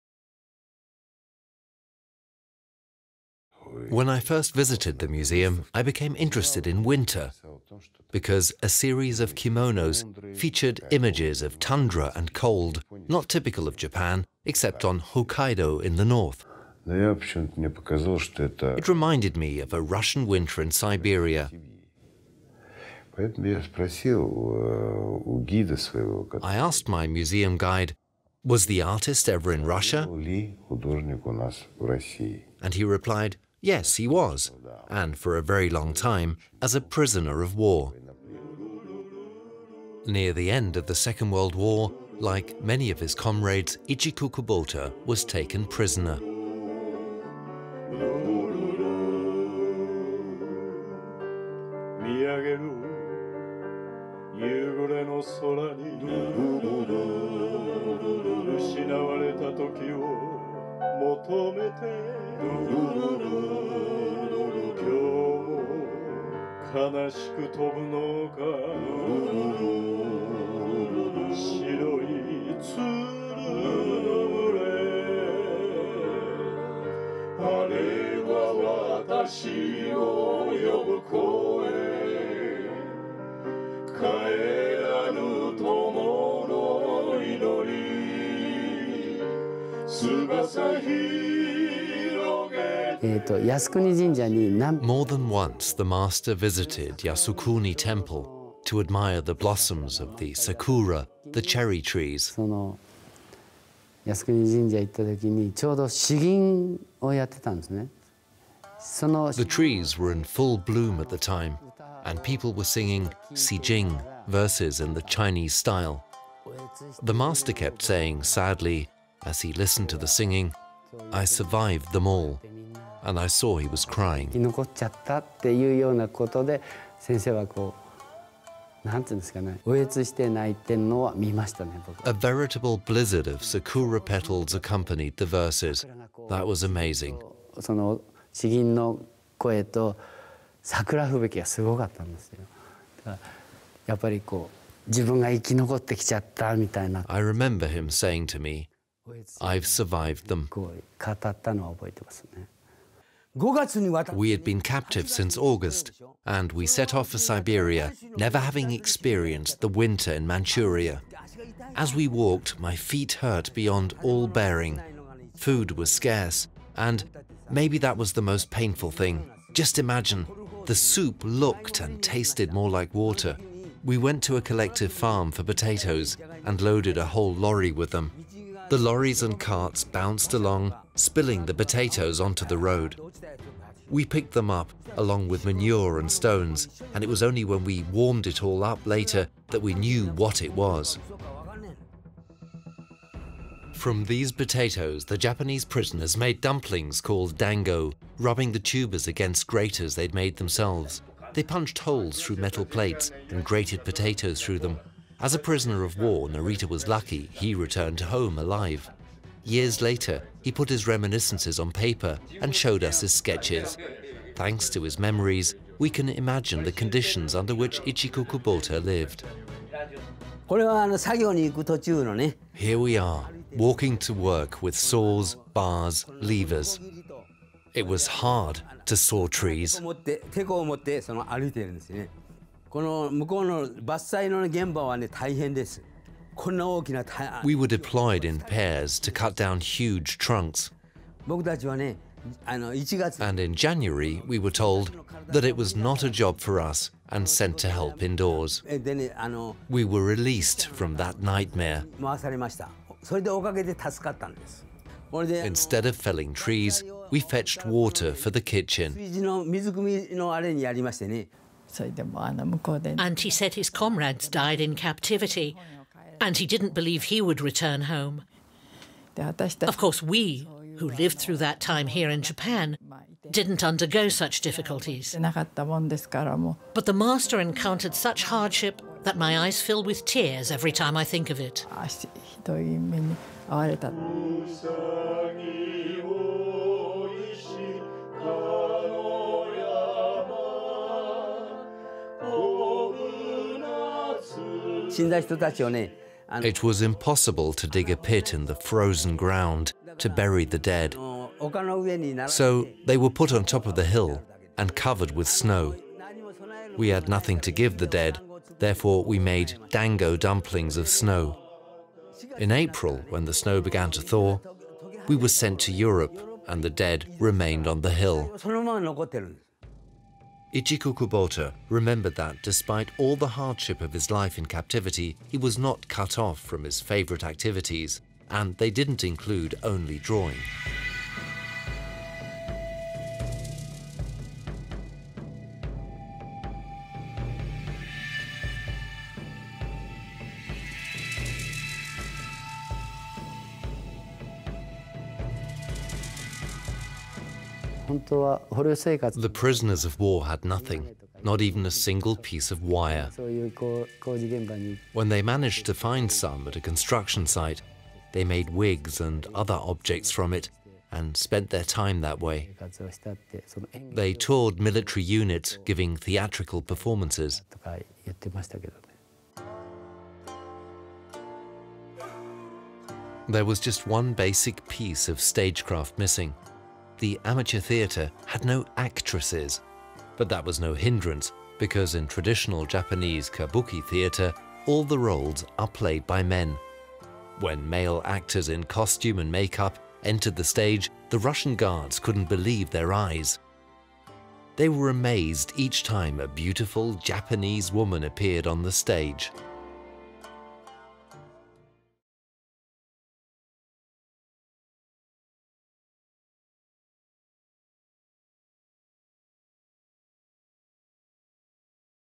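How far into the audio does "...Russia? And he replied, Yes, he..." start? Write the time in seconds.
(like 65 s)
29 s.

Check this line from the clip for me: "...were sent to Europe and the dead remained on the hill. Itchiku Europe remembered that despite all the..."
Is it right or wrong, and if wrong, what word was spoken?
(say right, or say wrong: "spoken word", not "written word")
wrong: "Kubota", not "Europe".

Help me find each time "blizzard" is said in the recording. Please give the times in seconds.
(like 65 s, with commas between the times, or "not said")
132 s.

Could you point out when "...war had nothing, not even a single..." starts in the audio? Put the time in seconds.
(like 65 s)
349 s.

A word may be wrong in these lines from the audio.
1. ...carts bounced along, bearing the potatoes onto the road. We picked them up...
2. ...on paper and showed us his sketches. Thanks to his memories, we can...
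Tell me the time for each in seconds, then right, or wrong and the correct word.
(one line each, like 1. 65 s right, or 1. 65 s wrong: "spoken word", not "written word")
1. 179 s wrong: "spilling", not "bearing"
2. 211 s right.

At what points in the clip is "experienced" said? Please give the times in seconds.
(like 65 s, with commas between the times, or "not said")
158 s.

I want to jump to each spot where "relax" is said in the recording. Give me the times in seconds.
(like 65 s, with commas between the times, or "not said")
not said.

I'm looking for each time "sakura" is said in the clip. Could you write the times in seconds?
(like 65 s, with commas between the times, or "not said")
100 s, 133 s.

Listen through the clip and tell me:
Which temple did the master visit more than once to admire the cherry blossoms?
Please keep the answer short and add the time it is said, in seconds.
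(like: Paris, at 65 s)
Yasukuni Temple, at 96 s.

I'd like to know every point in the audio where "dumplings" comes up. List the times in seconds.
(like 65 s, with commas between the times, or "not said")
196 s, 310 s.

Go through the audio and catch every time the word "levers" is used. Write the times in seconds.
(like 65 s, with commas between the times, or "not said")
226 s.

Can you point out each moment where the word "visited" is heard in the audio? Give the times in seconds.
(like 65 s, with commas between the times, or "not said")
4 s, 96 s.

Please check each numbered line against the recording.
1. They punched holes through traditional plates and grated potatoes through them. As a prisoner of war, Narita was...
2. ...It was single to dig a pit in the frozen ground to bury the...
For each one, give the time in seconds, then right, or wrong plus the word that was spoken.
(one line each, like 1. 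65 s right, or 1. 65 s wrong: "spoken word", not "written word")
1. 201 s wrong: "metal", not "traditional"
2. 294 s wrong: "impossible", not "single".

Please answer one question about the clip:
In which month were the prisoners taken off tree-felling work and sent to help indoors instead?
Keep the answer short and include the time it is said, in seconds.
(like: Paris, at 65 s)
January, at 243 s.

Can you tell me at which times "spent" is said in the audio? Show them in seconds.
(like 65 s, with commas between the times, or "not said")
361 s.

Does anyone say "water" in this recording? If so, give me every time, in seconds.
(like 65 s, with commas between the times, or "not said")
172 s, 257 s.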